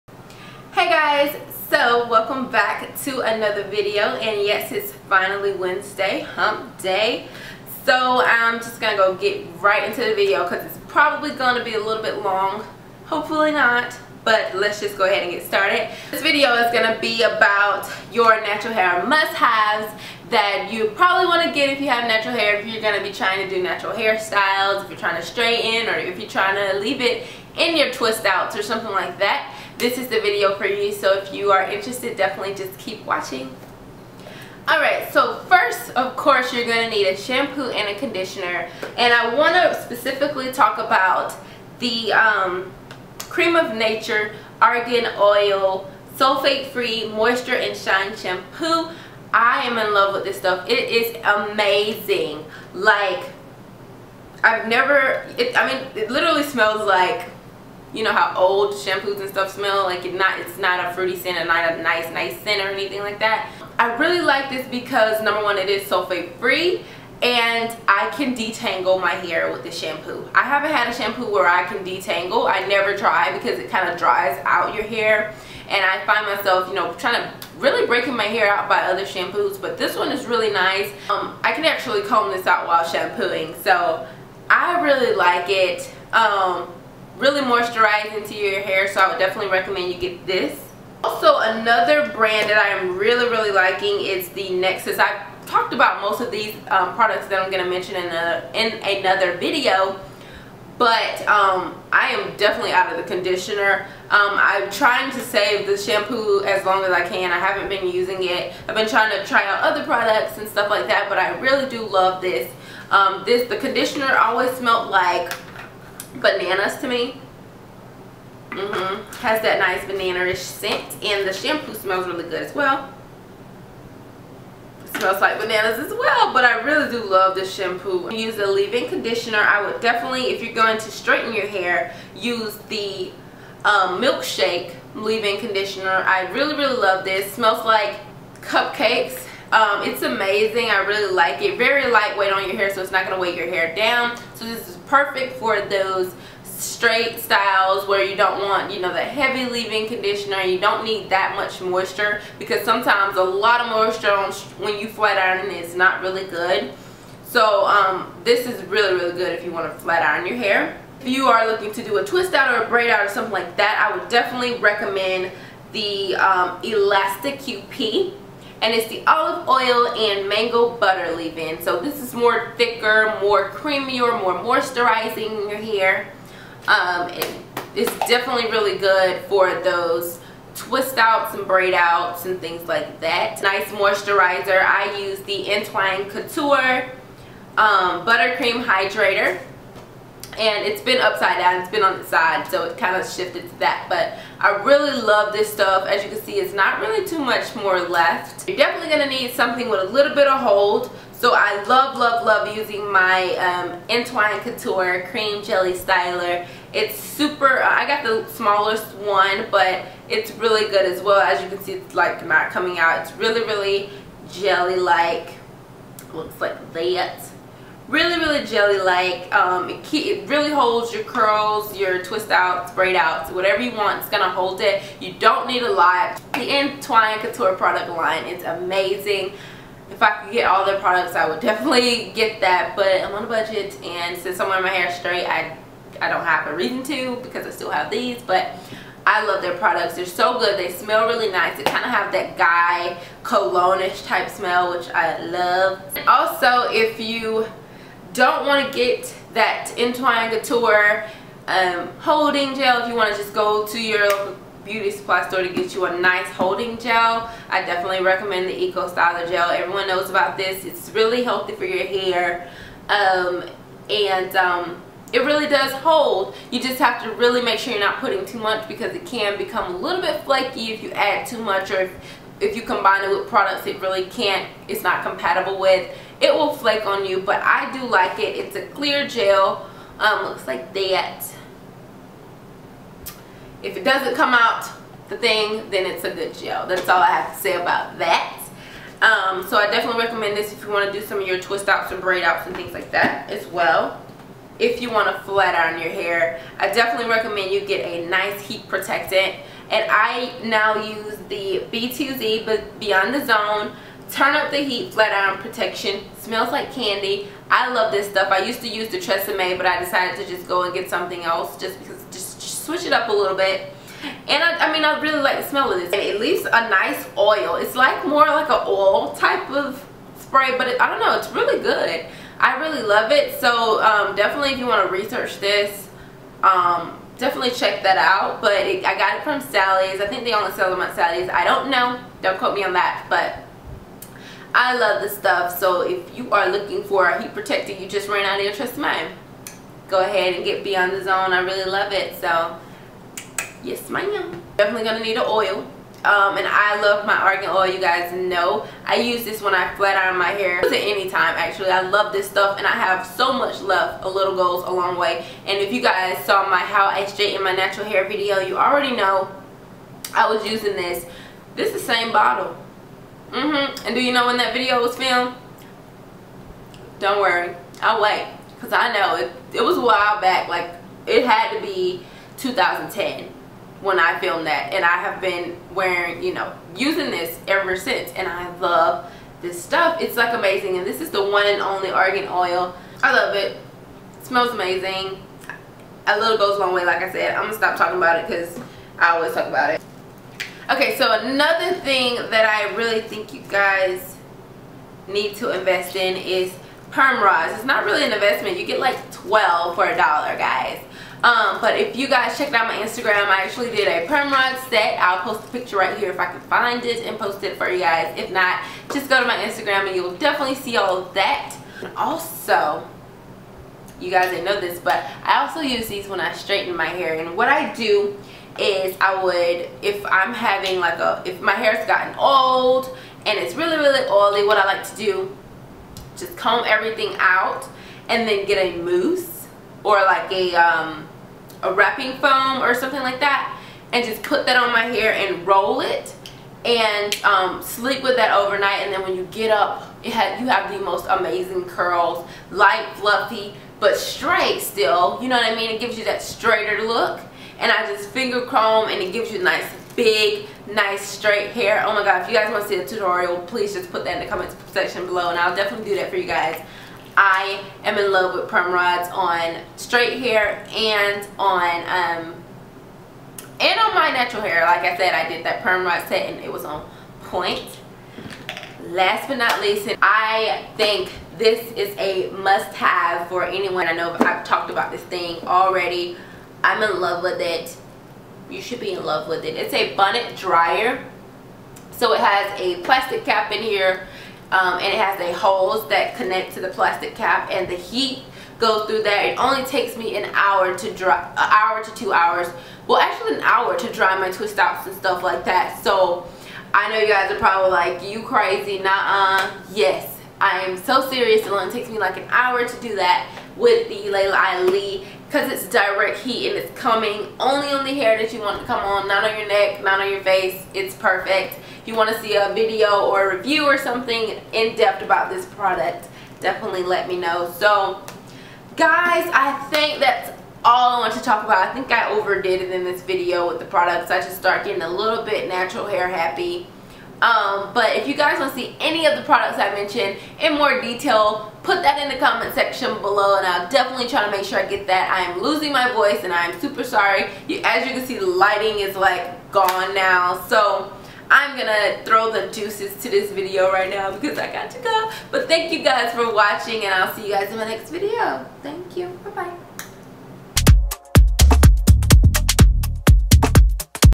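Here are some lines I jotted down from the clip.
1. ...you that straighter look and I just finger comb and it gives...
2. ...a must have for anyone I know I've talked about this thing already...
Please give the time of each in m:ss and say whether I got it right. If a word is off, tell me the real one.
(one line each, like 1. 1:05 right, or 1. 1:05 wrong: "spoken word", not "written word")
1. 7:25 right
2. 7:51 right.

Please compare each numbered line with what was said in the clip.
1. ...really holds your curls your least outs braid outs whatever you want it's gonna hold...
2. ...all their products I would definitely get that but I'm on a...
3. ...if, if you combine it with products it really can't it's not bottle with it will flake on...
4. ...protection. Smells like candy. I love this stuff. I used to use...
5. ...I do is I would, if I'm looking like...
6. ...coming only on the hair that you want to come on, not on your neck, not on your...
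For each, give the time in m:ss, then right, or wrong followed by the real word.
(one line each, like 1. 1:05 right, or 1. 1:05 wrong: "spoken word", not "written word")
1. 3:40 wrong: "twist", not "least"
2. 3:50 right
3. 4:31 wrong: "compatible", not "bottle"
4. 5:05 right
5. 6:57 wrong: "having", not "looking"
6. 8:26 right.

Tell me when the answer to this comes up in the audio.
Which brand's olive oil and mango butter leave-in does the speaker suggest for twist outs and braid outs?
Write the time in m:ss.
2:46.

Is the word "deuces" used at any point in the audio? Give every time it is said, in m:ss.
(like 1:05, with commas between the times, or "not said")
9:02.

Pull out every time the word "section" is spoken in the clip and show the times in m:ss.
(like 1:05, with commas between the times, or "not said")
7:34, 8:52.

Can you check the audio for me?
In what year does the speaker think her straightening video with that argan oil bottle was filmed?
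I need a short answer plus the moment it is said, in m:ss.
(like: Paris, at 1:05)
2010, at 6:12.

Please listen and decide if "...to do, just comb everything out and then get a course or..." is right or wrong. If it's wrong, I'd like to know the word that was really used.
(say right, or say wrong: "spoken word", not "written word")
wrong: "mousse", not "course".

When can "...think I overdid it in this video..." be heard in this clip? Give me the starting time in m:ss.
8:41.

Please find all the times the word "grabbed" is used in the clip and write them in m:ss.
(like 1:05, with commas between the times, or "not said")
not said.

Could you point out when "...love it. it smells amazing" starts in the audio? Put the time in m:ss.
6:23.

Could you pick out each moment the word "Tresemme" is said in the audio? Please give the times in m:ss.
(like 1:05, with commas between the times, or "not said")
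5:08, 5:38.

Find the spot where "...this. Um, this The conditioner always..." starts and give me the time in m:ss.
1:52.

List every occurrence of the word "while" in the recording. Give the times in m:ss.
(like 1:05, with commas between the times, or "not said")
1:22, 6:09.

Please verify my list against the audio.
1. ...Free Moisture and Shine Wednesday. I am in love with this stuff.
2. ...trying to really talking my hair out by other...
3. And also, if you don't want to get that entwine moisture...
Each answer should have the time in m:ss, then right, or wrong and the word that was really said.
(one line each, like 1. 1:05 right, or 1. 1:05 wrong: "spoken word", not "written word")
1. 0:46 wrong: "Shampoo", not "Wednesday"
2. 1:16 wrong: "breaking", not "talking"
3. 4:05 wrong: "couture", not "moisture".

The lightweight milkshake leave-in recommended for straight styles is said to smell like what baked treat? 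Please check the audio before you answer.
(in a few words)
Cupcakes.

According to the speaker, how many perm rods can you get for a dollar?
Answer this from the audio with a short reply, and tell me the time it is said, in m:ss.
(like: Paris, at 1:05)
12, at 6:39.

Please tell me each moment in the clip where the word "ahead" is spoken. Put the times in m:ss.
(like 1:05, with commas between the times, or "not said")
0:15, 5:40.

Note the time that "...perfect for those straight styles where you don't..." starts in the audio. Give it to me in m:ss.
2:24.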